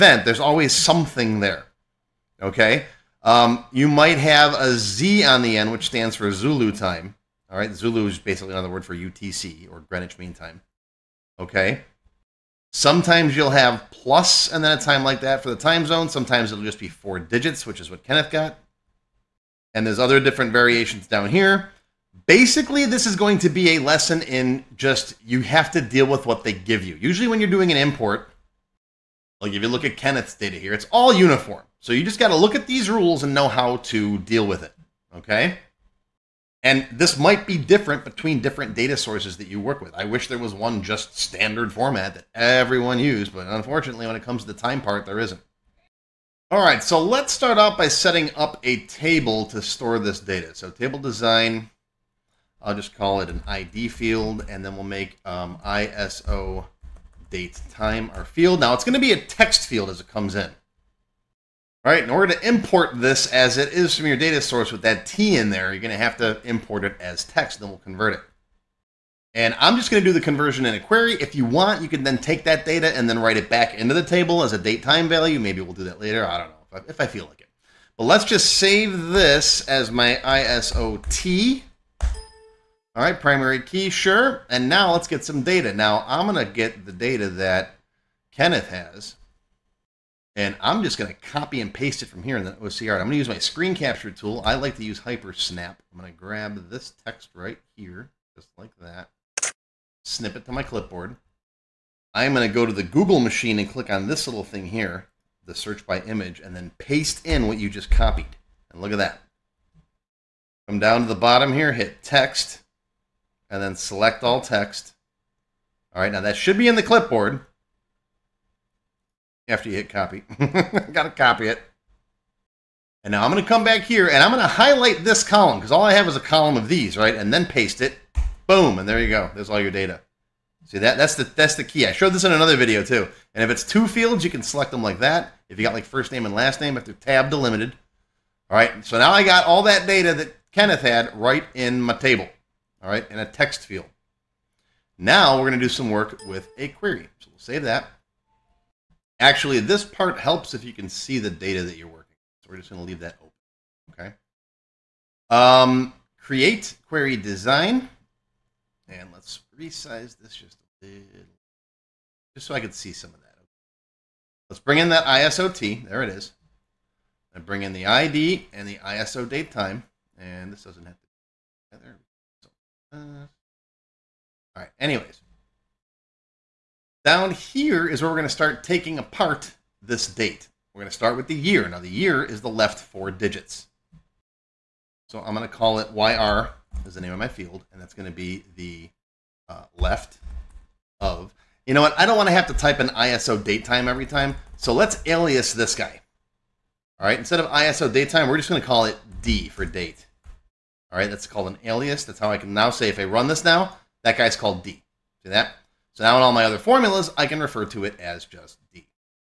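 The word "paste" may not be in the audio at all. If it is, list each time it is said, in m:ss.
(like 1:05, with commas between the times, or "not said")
1:31, 1:46, 2:07.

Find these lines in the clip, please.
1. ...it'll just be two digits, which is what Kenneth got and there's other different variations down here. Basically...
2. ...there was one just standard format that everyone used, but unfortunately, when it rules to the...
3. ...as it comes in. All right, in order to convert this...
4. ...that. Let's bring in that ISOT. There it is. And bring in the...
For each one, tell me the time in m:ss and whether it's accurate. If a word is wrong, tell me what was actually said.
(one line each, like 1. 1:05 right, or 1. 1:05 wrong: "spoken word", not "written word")
1. 0:16 wrong: "four", not "two"
2. 0:40 wrong: "comes", not "rules"
3. 0:59 wrong: "import", not "convert"
4. 2:43 right.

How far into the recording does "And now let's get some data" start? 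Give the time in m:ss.
1:24.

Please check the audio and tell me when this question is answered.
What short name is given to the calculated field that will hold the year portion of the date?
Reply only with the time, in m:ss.
3:05.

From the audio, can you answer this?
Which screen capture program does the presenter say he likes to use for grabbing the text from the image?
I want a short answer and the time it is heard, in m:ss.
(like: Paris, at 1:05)
Hypersnap, at 1:35.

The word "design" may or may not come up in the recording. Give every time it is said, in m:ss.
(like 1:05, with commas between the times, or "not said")
0:50, 2:37.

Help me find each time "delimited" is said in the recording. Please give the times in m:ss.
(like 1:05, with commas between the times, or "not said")
2:17.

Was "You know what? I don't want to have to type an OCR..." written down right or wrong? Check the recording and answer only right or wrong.
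wrong.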